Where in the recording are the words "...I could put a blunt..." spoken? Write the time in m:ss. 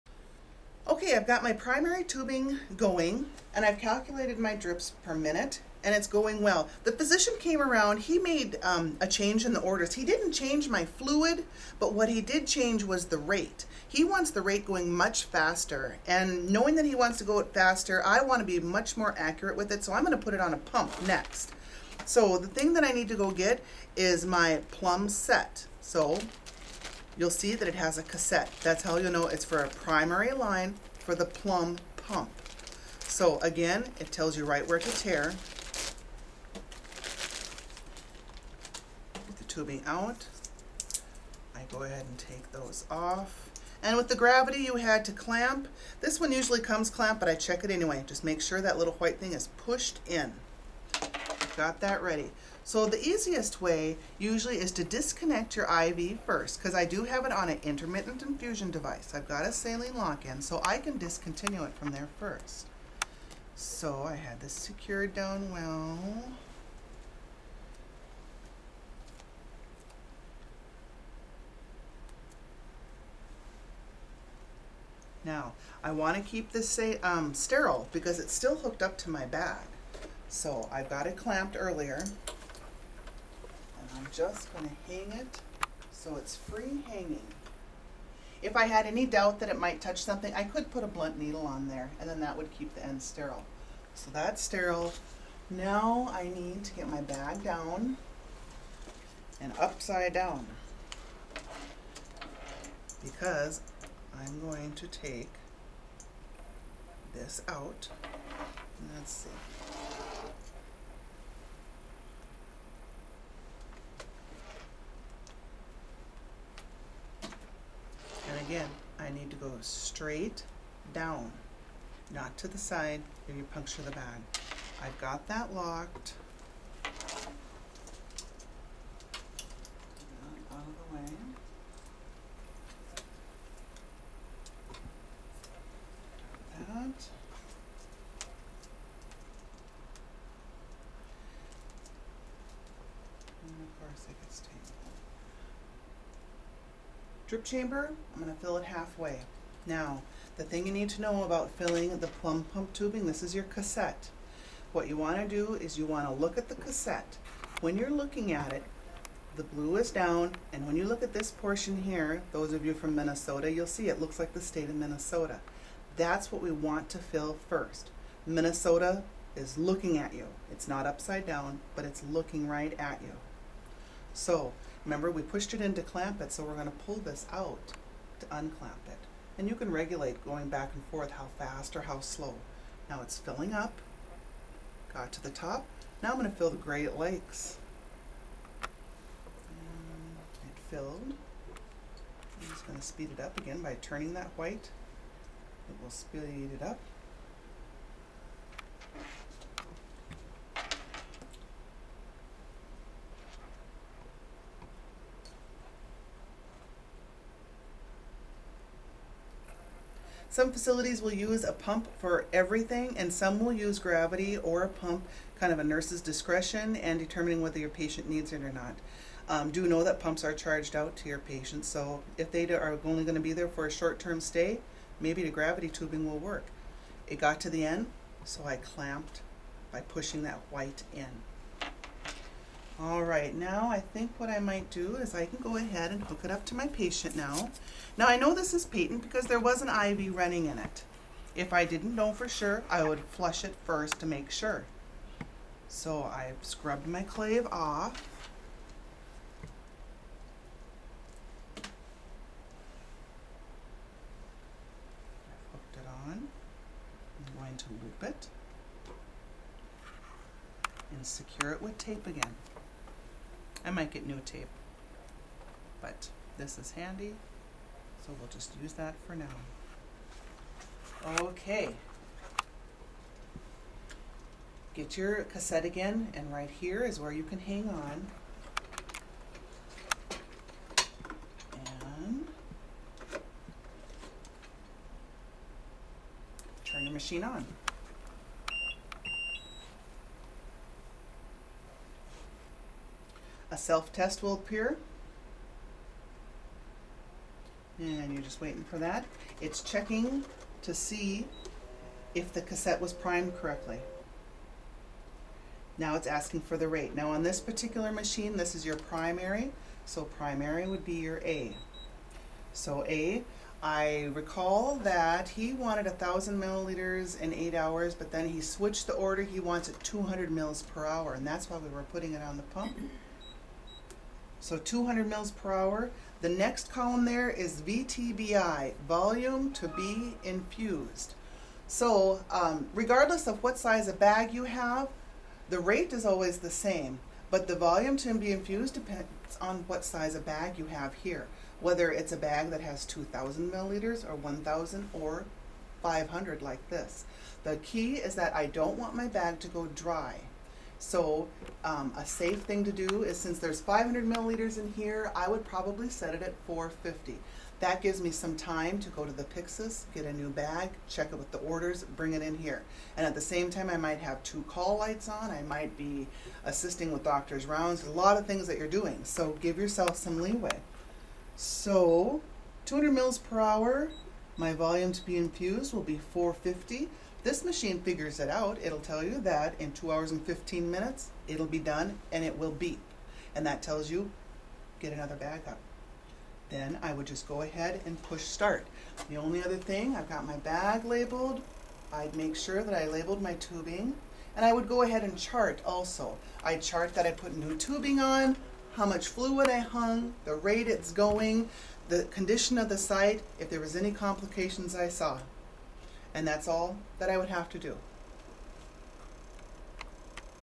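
1:30.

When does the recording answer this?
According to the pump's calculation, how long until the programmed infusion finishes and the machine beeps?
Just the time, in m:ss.
6:19.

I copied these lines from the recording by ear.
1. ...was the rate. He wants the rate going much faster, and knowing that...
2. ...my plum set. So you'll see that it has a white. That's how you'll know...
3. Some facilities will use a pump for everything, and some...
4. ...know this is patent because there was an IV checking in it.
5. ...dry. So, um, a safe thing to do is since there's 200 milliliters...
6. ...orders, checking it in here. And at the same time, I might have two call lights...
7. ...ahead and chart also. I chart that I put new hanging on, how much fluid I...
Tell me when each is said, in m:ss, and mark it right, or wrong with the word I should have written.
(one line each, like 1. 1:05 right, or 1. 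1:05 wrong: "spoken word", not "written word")
1. 0:12 right
2. 0:24 wrong: "cassette", not "white"
3. 3:30 right
4. 3:58 wrong: "running", not "checking"
5. 5:49 wrong: "500", not "200"
6. 6:01 wrong: "bring", not "checking"
7. 6:34 wrong: "tubing", not "hanging".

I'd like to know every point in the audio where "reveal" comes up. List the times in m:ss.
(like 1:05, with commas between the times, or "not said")
not said.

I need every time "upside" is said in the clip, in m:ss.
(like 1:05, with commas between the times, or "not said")
1:39, 2:50.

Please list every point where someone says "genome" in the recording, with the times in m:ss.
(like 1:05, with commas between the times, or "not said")
not said.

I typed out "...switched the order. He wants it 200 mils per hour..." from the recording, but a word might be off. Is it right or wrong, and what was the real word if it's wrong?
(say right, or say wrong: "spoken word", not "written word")
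right.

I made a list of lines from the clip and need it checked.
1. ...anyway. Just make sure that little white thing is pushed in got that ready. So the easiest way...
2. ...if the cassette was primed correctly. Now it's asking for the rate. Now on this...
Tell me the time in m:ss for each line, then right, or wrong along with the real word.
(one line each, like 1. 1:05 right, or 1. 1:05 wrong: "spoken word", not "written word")
1. 0:47 right
2. 5:02 right.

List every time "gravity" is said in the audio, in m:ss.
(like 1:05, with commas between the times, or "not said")
0:44, 3:33, 3:45.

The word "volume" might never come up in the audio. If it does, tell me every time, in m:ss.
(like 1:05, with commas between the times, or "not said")
5:28, 5:37, 6:14.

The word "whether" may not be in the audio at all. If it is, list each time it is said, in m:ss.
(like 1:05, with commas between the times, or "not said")
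3:37, 5:41.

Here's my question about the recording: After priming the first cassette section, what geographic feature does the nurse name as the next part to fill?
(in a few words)
Great Lakes.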